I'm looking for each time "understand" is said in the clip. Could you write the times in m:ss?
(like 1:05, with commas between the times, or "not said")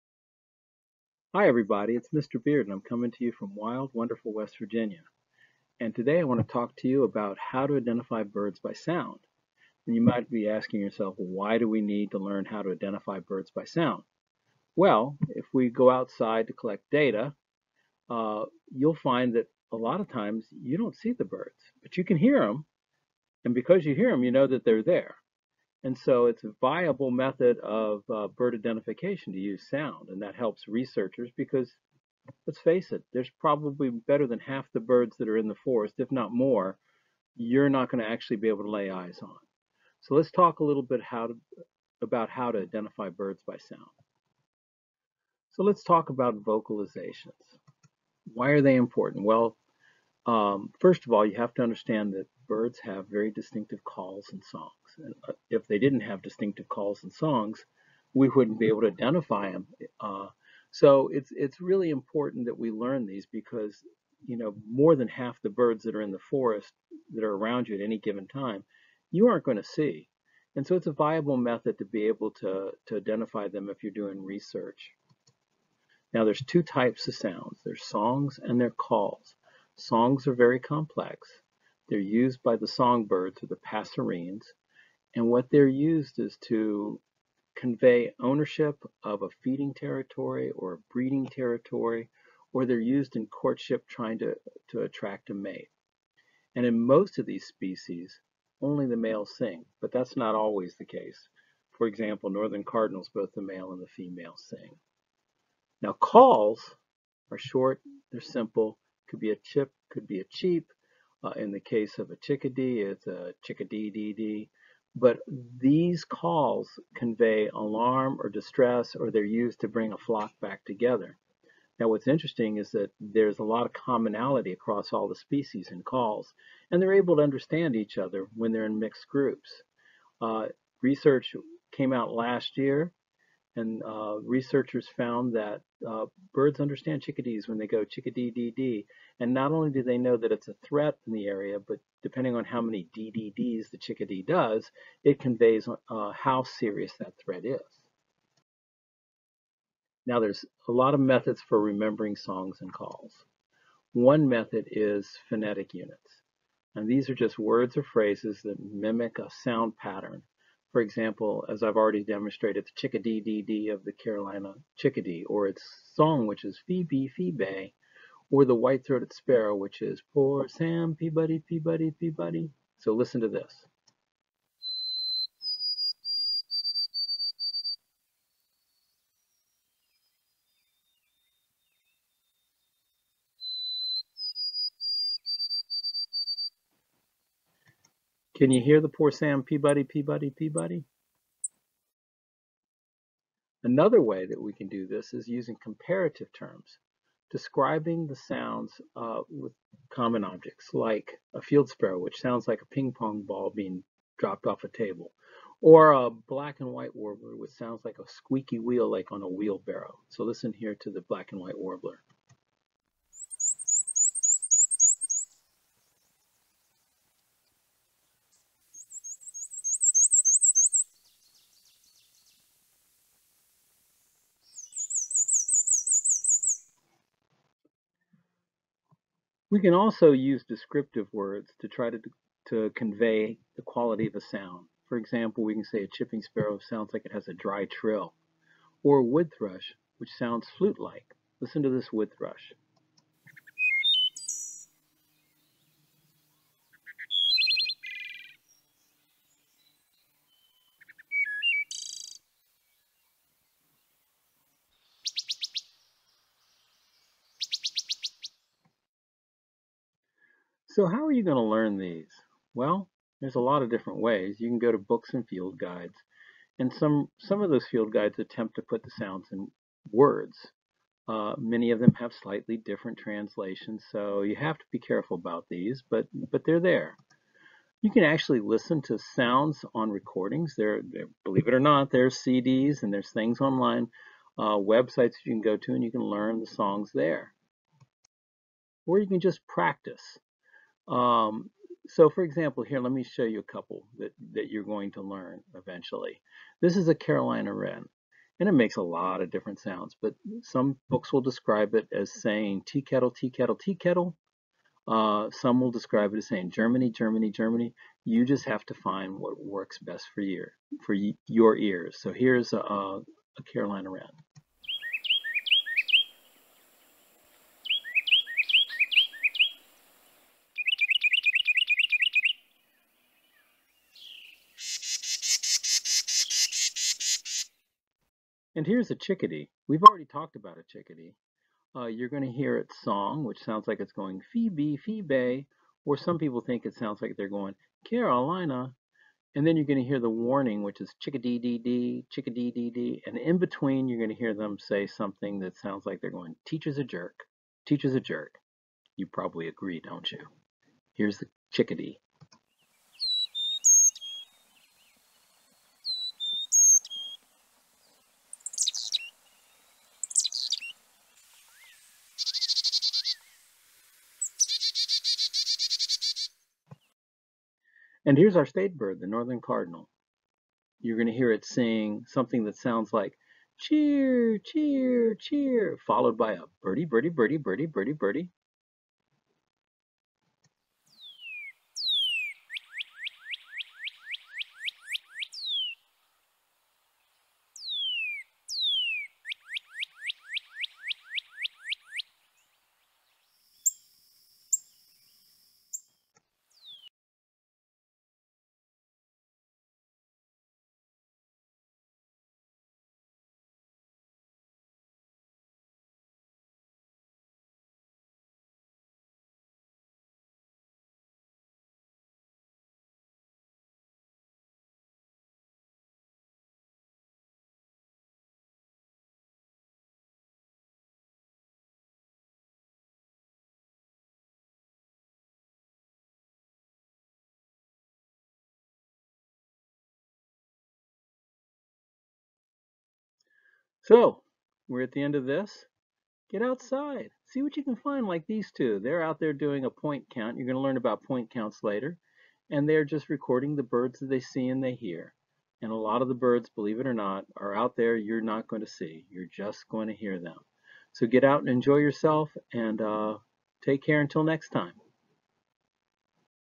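0:51, 2:07, 2:16.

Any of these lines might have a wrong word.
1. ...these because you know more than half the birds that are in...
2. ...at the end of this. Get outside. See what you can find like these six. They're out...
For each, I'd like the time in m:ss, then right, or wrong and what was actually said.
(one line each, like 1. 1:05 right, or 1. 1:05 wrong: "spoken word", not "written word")
1. 1:03 right
2. 7:14 wrong: "two", not "six".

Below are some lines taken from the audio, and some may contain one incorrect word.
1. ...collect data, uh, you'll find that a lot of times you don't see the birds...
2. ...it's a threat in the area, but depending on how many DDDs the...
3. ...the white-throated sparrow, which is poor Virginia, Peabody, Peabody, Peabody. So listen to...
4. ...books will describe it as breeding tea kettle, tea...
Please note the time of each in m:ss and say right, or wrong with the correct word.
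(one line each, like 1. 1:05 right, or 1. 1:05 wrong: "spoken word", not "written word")
1. 0:16 right
2. 2:20 right
3. 2:48 wrong: "Sam", not "Virginia"
4. 5:00 wrong: "saying", not "breeding".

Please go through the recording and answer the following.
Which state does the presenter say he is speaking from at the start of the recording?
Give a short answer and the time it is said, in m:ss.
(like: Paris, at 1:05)
West Virginia, at 0:04.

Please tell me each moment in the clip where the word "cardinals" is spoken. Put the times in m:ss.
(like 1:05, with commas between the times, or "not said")
1:42, 6:09.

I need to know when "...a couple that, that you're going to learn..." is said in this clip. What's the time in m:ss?
4:53.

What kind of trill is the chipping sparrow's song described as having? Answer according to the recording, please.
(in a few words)
Dry trill.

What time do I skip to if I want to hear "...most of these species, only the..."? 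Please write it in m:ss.
1:36.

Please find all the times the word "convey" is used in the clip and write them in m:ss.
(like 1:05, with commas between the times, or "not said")
1:27, 1:56, 2:25, 3:52.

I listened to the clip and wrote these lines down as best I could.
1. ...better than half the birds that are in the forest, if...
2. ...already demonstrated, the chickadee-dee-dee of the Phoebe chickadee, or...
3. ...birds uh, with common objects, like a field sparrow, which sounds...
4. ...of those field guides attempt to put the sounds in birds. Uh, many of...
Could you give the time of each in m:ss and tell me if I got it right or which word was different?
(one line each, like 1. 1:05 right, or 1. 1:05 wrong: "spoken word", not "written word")
1. 0:33 right
2. 2:41 wrong: "Carolina", not "Phoebe"
3. 3:18 wrong: "sounds", not "birds"
4. 4:27 wrong: "words", not "birds".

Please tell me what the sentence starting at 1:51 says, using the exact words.
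Uh, in the case of a chickadee, it's a chickadee-dee-dee.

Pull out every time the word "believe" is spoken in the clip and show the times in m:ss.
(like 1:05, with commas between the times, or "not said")
4:41, 7:26.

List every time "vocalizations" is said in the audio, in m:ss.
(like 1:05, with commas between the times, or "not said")
0:46.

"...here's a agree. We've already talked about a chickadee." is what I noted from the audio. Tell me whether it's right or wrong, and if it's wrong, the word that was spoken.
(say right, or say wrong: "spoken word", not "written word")
wrong: "chickadee", not "agree".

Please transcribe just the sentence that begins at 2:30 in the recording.
Now there's a lot of methods for remembering songs and calls.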